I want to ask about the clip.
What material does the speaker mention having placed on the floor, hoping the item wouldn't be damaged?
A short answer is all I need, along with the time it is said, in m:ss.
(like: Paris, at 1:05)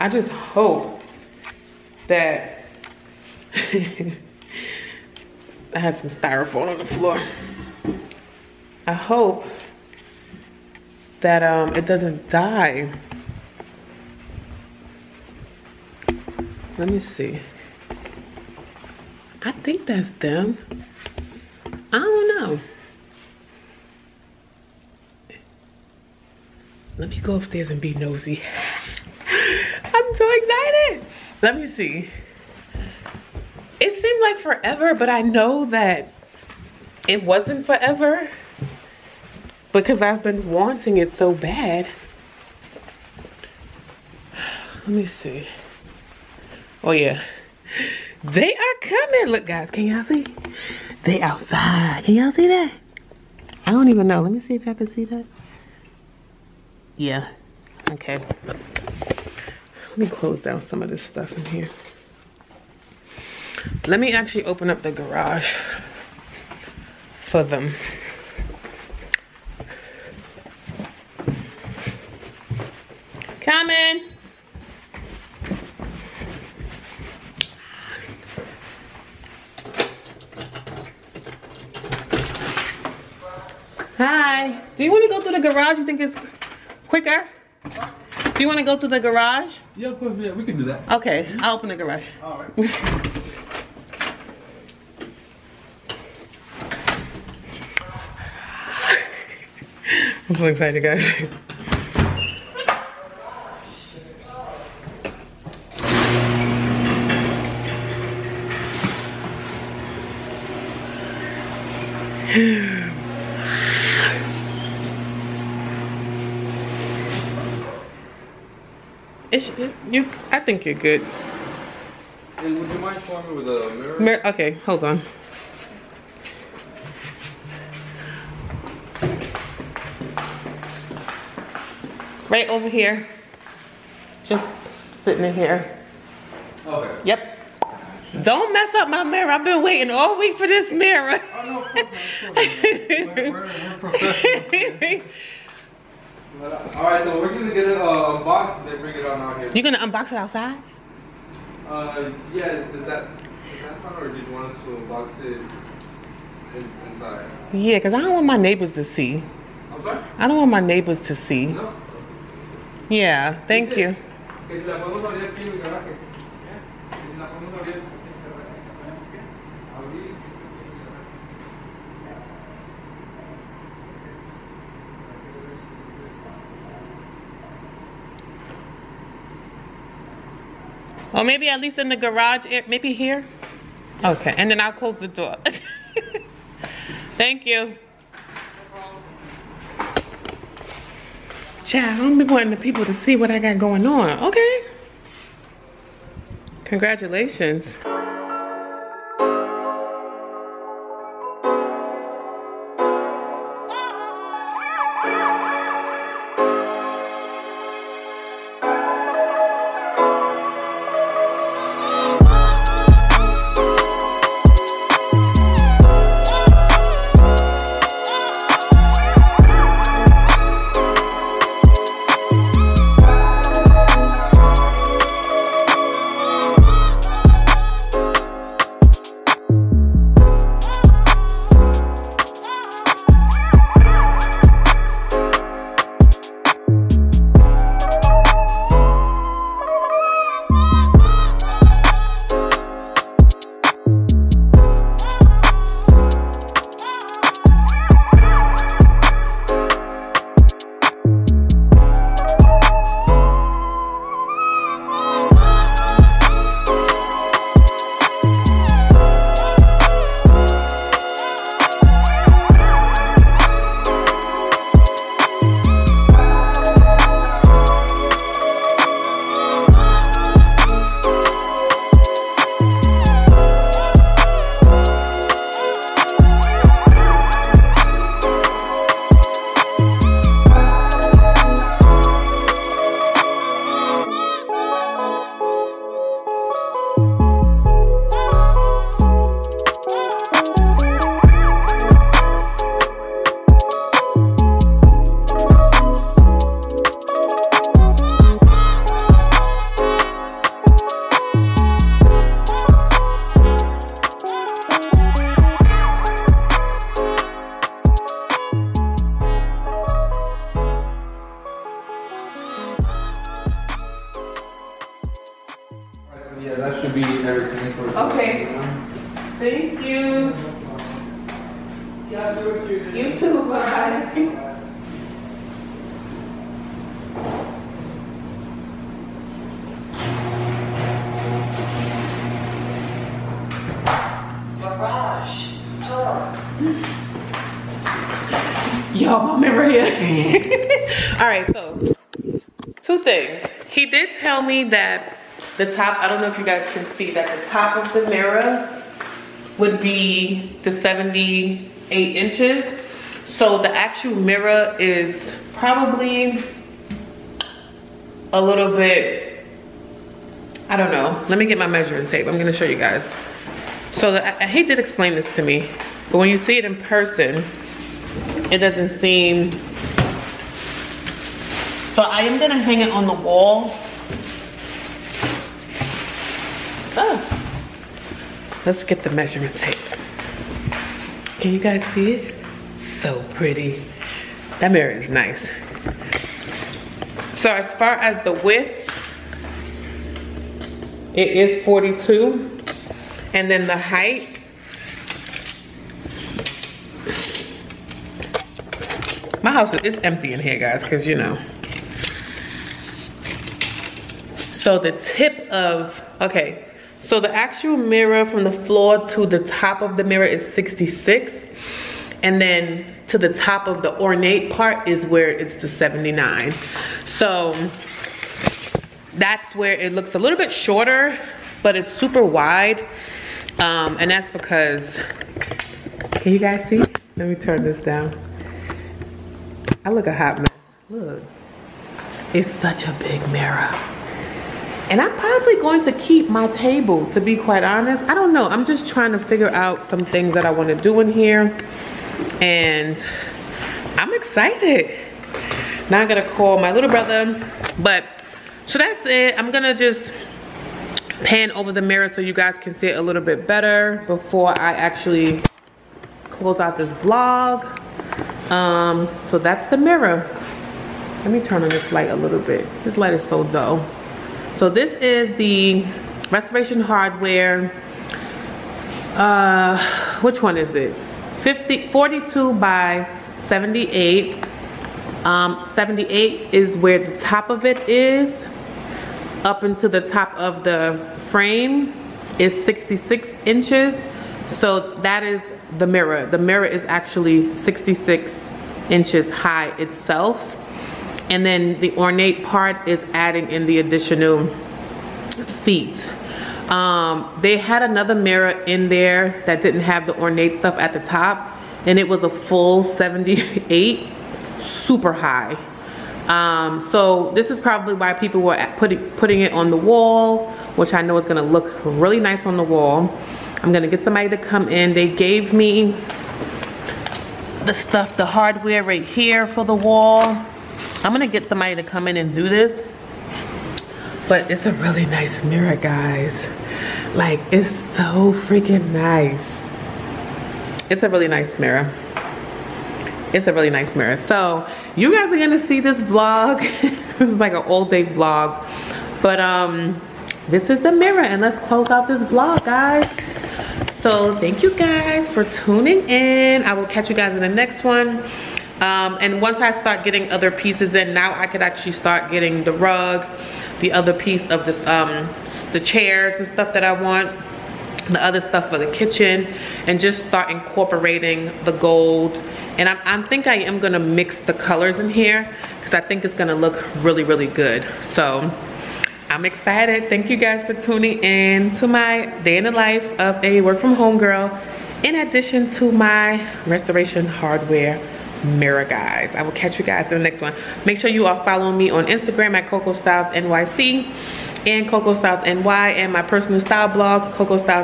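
styrofoam, at 0:06.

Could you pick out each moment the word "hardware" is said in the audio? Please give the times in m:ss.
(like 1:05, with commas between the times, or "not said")
7:46, 8:38, 9:37.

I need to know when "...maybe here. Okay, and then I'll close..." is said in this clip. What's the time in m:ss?
3:02.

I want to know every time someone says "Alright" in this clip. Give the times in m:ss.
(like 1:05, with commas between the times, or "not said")
2:26.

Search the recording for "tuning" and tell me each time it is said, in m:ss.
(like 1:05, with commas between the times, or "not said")
9:05, 9:30.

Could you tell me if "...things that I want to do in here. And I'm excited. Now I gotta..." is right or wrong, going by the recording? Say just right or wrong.
right.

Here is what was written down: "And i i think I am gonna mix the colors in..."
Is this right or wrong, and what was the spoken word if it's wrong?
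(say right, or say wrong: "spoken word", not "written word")
right.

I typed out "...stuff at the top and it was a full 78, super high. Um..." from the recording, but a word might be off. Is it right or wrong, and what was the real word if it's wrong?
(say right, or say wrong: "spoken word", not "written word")
right.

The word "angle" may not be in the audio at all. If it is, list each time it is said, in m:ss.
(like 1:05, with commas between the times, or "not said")
not said.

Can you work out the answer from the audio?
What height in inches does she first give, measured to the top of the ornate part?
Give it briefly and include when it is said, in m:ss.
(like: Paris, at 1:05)
79, at 6:55.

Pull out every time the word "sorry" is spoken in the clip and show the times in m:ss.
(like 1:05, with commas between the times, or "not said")
2:39.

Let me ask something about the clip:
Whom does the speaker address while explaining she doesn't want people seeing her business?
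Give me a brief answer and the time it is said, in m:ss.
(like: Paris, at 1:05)
Chad, at 3:11.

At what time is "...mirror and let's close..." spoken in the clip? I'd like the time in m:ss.
9:00.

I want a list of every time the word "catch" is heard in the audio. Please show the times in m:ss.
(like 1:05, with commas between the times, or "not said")
9:06, 9:39.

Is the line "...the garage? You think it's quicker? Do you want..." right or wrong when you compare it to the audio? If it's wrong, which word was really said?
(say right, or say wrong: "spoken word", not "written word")
right.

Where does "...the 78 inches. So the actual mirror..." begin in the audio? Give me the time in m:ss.
5:50.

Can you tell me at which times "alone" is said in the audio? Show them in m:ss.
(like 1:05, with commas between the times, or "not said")
not said.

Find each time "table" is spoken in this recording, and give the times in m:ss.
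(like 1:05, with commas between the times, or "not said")
7:16.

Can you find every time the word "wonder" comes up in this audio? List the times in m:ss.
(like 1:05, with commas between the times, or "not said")
not said.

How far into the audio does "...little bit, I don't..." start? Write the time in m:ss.
5:58.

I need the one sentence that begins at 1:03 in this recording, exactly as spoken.
Let me actually open up the garage for them.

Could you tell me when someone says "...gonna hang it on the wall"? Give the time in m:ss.
6:12.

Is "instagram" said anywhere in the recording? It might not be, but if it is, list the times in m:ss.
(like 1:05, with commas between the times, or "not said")
9:42.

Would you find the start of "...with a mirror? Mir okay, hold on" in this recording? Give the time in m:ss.
2:03.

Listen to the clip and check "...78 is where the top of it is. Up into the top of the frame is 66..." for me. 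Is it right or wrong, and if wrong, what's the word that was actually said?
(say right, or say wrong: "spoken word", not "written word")
right.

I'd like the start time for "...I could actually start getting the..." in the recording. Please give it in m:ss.
9:11.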